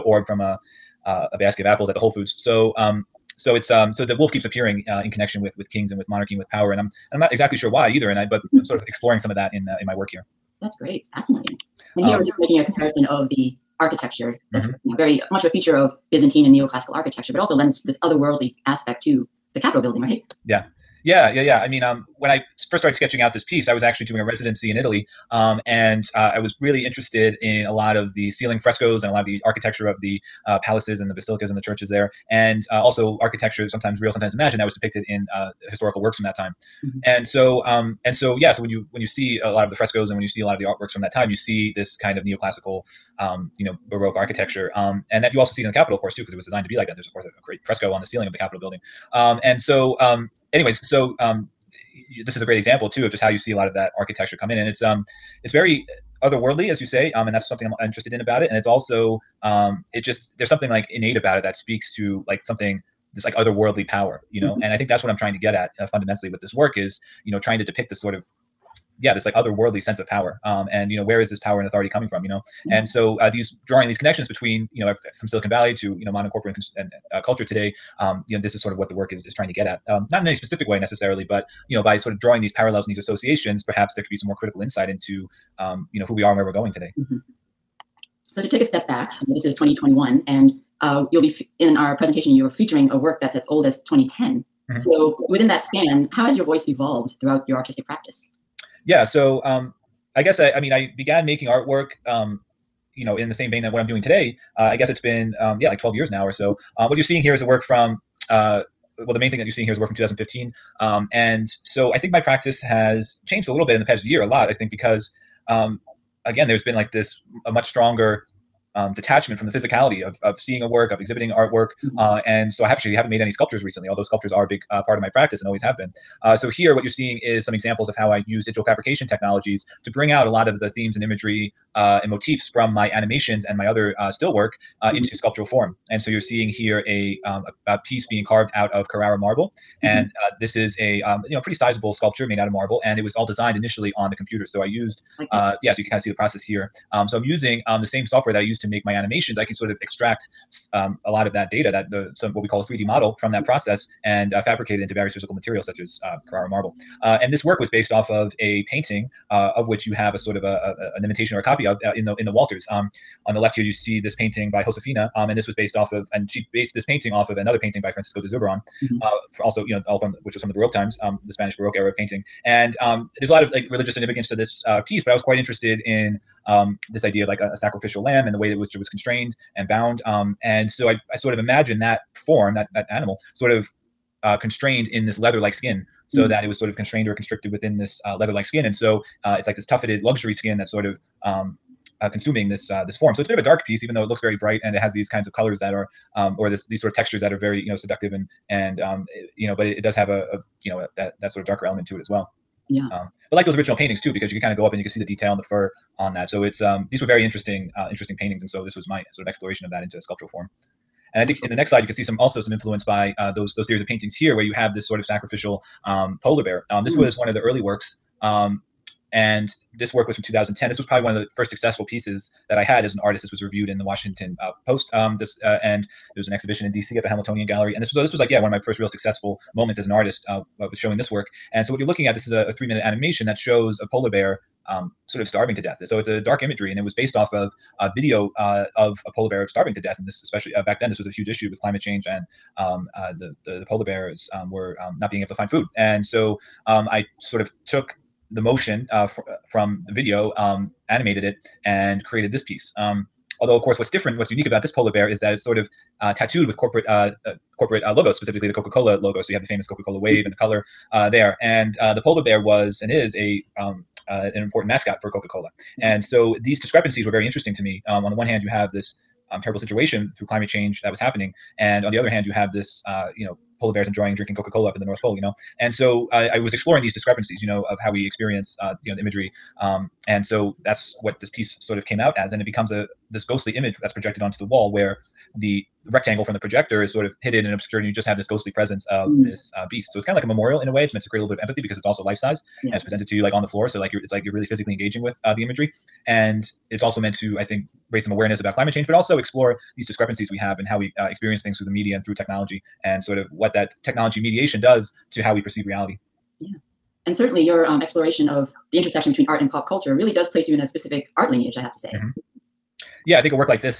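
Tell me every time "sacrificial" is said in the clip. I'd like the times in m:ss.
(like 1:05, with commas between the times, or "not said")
2:57, 3:35.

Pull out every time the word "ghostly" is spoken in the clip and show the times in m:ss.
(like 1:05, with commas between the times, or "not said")
4:43, 4:48.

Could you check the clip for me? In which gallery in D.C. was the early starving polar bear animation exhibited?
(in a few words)
Hamiltonian Gallery.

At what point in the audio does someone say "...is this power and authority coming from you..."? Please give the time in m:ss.
1:11.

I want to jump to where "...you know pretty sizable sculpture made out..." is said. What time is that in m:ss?
2:21.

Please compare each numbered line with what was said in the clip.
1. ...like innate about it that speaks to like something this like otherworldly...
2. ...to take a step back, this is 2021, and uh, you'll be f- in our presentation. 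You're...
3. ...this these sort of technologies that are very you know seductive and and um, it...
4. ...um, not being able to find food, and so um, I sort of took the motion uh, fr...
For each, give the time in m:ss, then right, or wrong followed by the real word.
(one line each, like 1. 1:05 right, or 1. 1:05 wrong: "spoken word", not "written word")
1. 1:00 right
2. 1:28 right
3. 3:16 wrong: "textures", not "technologies"
4. 4:04 right.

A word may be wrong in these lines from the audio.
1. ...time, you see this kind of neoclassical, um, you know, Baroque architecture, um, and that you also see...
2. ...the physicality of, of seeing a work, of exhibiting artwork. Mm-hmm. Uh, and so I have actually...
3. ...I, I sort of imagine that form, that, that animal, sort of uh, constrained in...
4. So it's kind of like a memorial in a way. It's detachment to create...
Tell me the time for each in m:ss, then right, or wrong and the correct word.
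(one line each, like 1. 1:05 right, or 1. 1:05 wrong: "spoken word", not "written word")
1. 0:41 right
2. 1:59 right
3. 3:00 right
4. 4:49 wrong: "meant", not "detachment".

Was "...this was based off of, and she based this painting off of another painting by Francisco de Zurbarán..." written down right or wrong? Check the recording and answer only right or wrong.
right.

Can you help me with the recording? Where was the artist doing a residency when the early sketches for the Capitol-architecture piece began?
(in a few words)
Italy.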